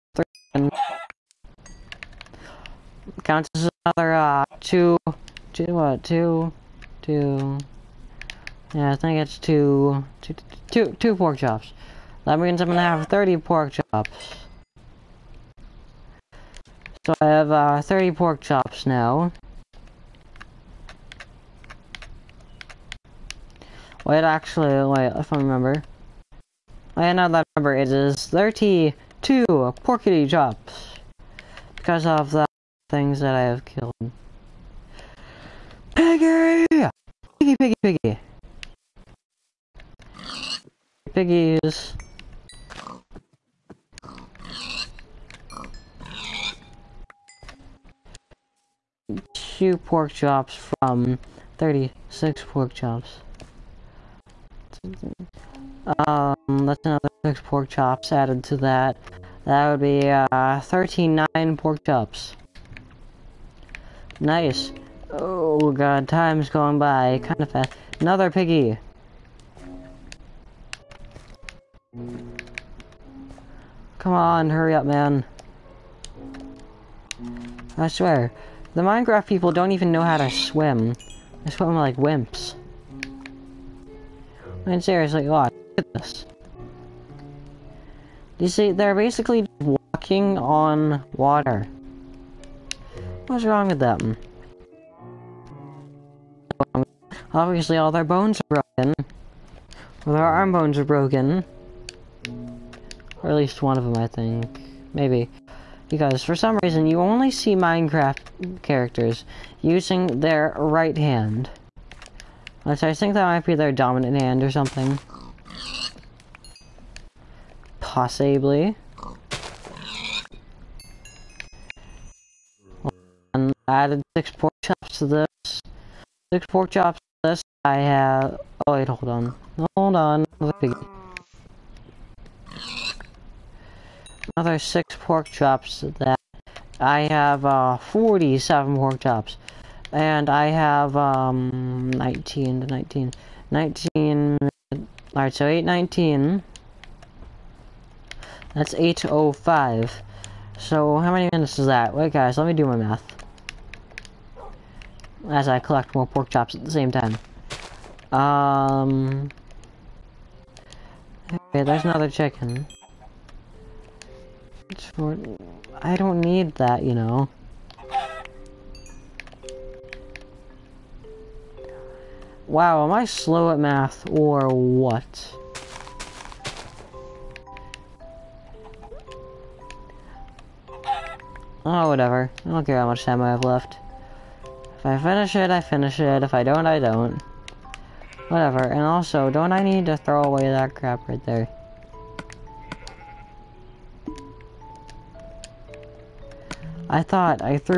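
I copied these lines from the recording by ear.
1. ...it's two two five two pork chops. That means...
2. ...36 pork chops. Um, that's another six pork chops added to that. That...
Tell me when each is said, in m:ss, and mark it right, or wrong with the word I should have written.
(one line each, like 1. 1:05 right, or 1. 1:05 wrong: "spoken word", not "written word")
1. 0:09 wrong: "two", not "five"
2. 0:51 right.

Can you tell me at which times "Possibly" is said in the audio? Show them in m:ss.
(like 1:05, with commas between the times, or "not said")
1:57.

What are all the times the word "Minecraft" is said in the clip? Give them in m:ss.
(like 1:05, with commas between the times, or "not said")
1:18, 1:47.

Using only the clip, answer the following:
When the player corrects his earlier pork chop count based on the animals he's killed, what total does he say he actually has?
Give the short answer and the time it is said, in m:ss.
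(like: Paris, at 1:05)
32, at 0:28.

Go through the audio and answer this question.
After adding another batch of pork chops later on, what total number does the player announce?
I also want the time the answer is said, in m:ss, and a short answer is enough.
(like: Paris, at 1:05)
47, at 2:17.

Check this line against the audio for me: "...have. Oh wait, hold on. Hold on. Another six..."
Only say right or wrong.
right.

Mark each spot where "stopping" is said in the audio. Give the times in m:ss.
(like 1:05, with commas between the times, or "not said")
not said.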